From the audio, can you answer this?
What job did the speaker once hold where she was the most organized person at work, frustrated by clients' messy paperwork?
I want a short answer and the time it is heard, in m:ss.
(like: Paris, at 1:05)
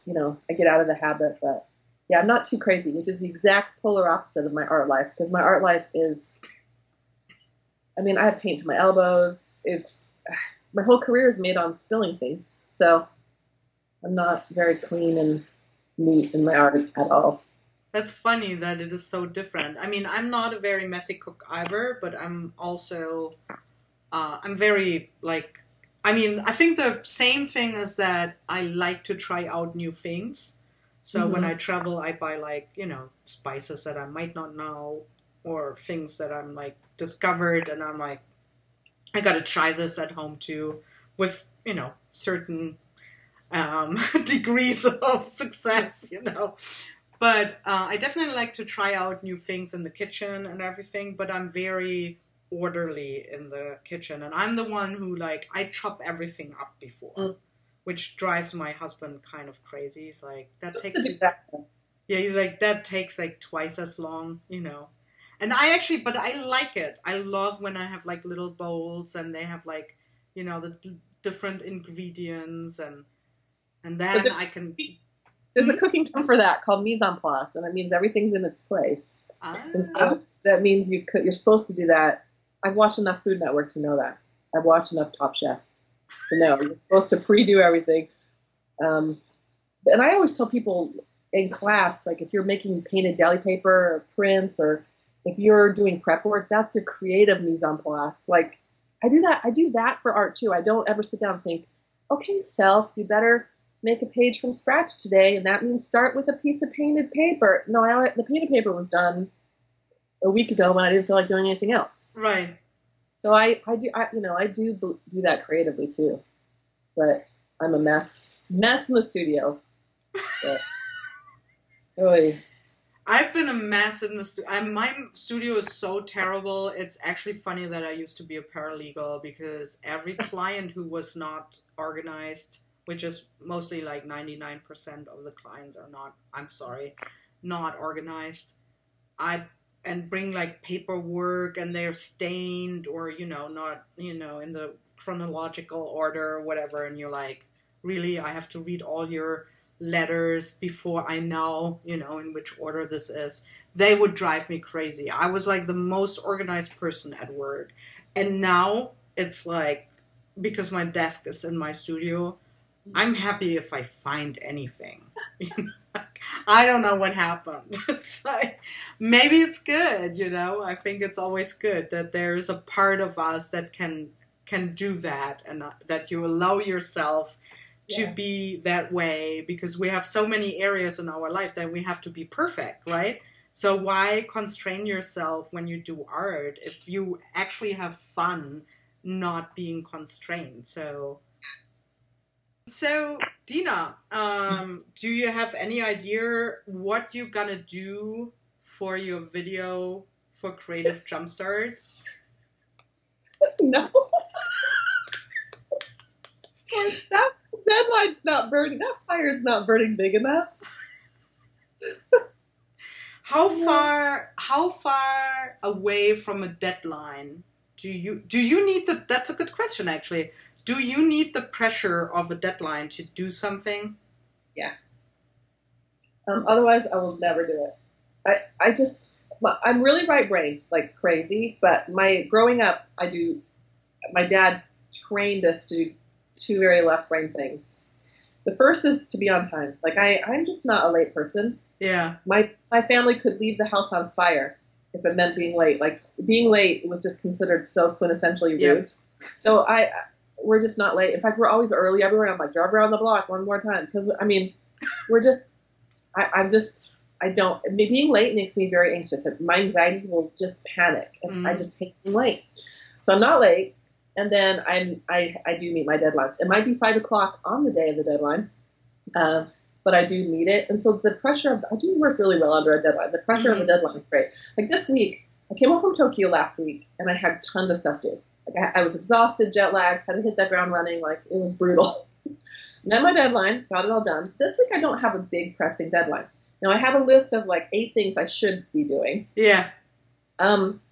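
paralegal, at 2:08.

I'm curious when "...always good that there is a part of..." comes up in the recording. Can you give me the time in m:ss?
2:51.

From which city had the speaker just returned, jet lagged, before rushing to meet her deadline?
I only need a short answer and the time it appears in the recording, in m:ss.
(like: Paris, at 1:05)
Tokyo, at 4:35.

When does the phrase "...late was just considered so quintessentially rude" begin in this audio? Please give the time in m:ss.
4:06.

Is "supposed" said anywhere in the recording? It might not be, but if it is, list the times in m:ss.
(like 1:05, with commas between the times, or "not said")
1:21, 1:27.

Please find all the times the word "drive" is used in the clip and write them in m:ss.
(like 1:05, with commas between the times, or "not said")
0:58, 2:34, 4:12.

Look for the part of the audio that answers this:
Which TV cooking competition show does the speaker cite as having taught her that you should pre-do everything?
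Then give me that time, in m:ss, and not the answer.
1:25.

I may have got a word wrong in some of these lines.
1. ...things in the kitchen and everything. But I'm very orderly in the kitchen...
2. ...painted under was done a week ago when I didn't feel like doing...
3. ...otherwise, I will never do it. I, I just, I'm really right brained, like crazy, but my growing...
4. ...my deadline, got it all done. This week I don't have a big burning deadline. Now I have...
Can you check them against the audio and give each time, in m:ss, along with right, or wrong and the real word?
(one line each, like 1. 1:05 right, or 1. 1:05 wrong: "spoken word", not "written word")
1. 0:49 right
2. 1:48 wrong: "paper", not "under"
3. 3:46 right
4. 4:43 wrong: "pressing", not "burning".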